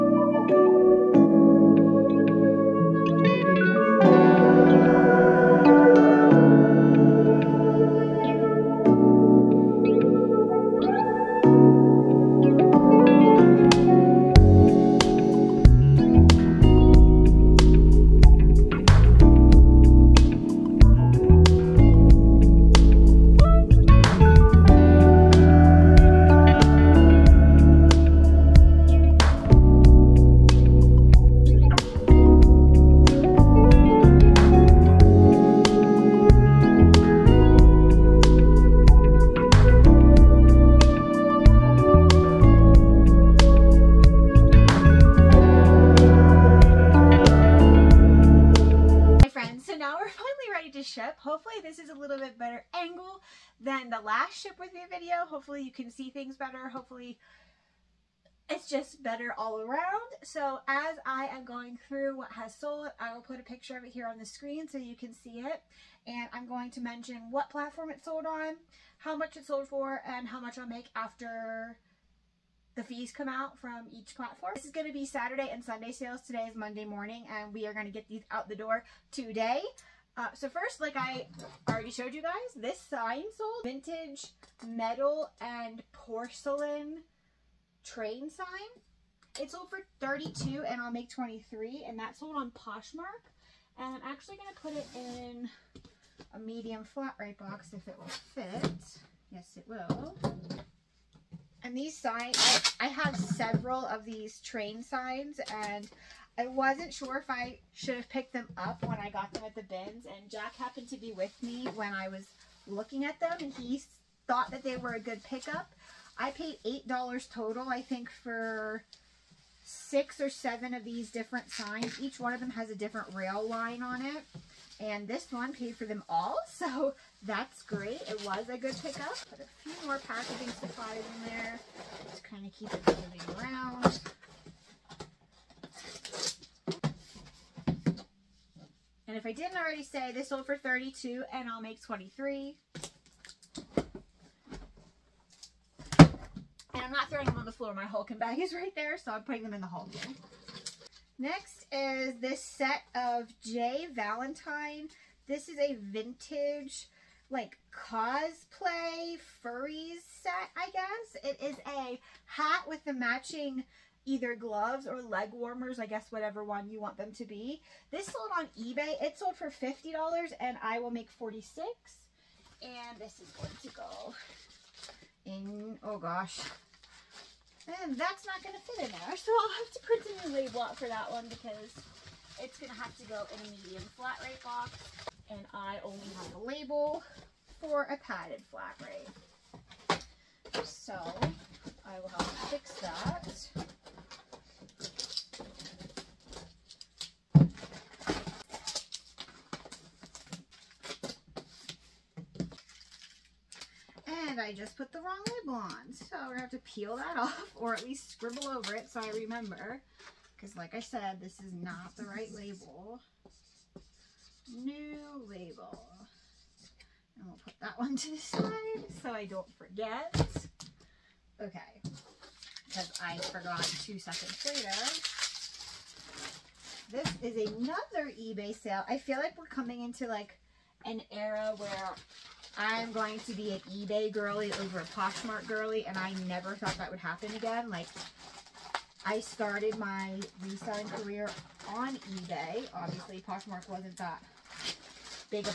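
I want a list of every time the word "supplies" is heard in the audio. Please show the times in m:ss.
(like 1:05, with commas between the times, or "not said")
2:10.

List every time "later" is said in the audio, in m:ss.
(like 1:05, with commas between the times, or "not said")
3:44.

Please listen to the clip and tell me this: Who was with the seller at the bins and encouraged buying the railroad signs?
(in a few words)
Jack.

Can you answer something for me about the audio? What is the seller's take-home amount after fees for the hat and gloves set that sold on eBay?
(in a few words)
46.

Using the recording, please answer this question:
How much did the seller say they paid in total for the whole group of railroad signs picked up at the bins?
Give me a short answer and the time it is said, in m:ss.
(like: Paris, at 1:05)
$8, at 1:56.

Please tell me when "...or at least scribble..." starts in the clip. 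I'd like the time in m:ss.
3:27.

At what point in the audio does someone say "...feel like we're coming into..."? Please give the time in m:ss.
3:48.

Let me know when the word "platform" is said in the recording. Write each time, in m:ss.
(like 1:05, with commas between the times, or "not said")
1:07, 1:14.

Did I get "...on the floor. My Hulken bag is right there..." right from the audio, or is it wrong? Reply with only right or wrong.
right.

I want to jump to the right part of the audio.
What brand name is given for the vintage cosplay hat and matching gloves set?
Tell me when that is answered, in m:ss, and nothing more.
2:33.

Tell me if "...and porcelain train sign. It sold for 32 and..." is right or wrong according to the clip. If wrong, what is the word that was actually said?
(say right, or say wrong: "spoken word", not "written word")
right.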